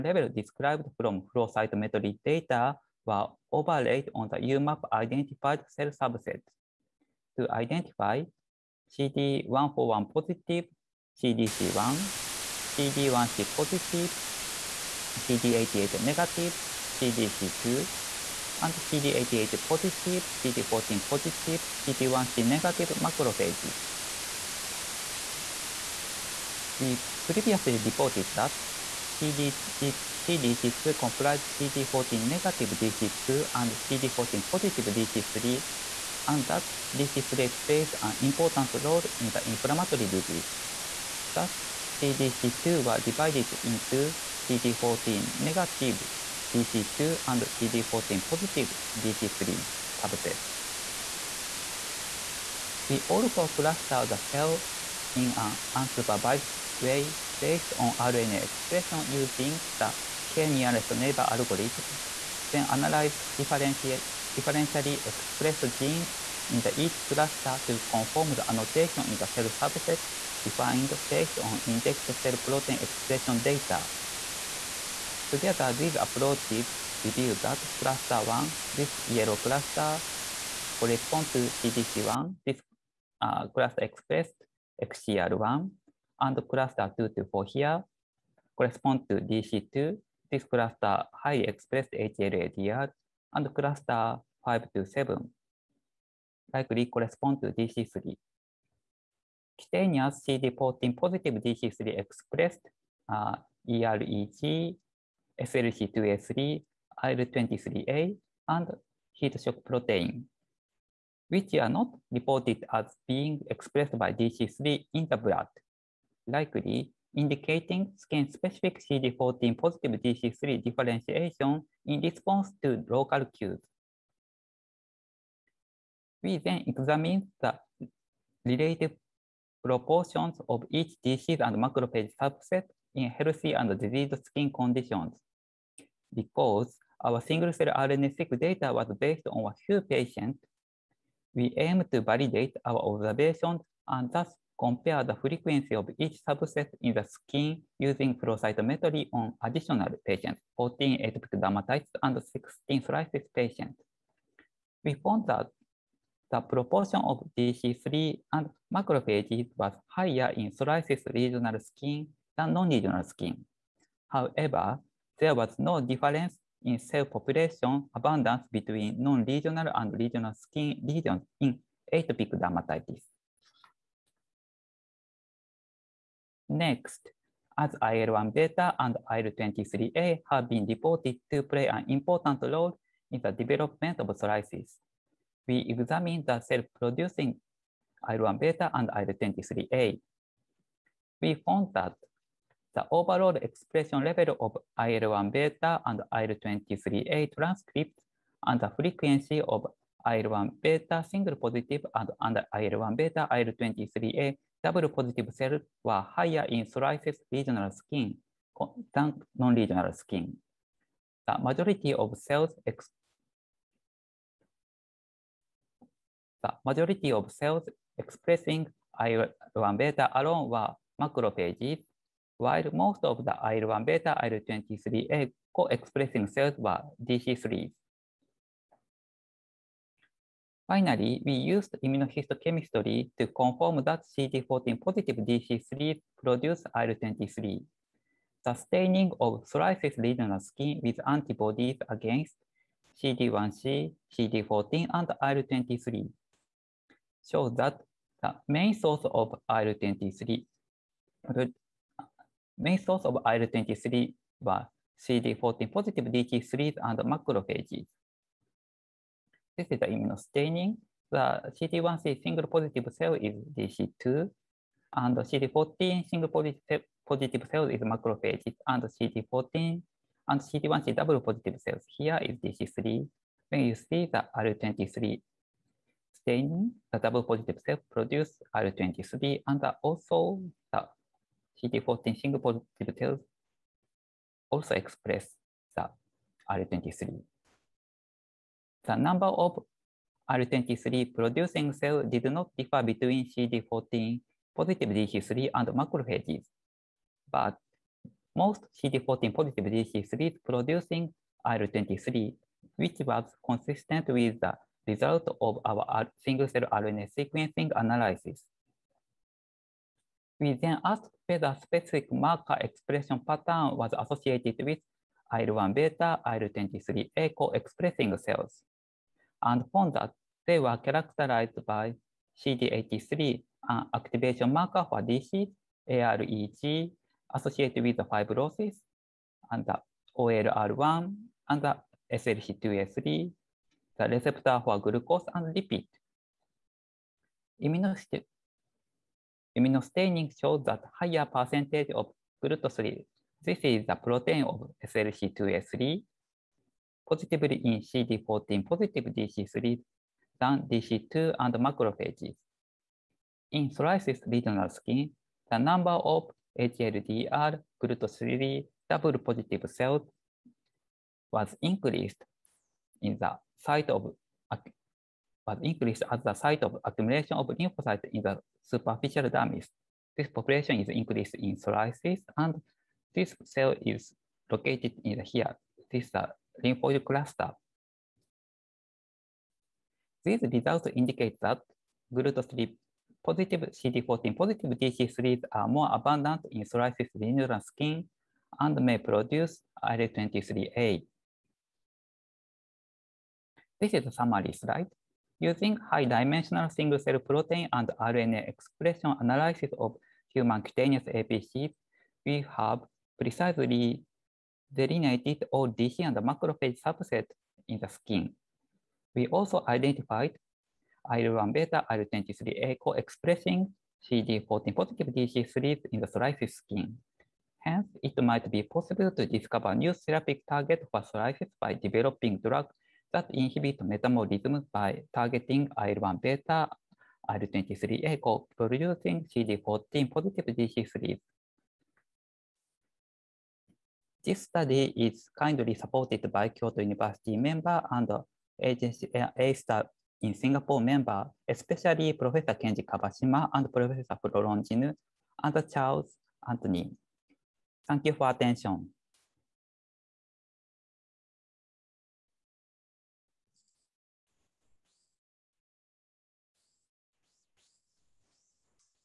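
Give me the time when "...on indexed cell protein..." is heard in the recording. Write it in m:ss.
1:11.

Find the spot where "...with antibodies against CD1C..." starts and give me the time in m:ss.
4:00.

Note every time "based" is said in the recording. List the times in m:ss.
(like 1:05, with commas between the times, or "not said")
0:57, 1:11, 2:18.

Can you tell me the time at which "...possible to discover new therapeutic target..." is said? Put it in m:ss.
6:58.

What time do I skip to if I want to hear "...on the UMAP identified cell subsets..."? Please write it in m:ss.
0:04.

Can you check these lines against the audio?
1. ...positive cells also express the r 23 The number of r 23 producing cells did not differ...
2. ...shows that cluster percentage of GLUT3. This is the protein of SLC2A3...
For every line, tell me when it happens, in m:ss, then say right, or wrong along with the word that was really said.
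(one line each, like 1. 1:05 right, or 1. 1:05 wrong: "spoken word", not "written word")
1. 4:42 right
2. 5:40 wrong: "higher", not "cluster".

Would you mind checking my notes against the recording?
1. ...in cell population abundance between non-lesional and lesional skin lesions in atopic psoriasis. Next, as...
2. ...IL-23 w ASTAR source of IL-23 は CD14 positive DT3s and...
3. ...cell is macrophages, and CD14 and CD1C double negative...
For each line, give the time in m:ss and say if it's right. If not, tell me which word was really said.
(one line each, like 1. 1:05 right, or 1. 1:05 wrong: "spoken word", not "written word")
1. 2:46 wrong: "dermatitis", not "psoriasis"
2. 4:09 wrong: "Main", not "ASTAR"
3. 4:27 wrong: "positive", not "negative".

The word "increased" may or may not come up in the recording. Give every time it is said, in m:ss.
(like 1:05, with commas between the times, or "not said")
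6:01, 6:05, 6:10.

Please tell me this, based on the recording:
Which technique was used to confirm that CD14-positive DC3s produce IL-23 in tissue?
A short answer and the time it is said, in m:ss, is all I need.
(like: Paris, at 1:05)
immunohistochemistry, at 3:51.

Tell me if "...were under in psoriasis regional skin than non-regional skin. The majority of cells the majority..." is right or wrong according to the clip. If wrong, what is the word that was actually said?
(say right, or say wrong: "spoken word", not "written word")
wrong: "higher", not "under".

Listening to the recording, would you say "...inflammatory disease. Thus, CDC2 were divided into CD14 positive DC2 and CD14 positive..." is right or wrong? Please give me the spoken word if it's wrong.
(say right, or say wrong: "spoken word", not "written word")
wrong: "negative", not "positive".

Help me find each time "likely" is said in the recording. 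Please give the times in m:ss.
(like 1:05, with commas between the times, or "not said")
1:36, 1:56.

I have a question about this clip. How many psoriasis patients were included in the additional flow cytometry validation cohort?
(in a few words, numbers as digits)
16.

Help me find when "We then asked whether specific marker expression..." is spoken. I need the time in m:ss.
5:10.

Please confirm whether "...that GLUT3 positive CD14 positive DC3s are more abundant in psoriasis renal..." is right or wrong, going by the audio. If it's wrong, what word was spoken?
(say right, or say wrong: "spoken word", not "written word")
right.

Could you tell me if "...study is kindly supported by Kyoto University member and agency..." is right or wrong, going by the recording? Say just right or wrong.
right.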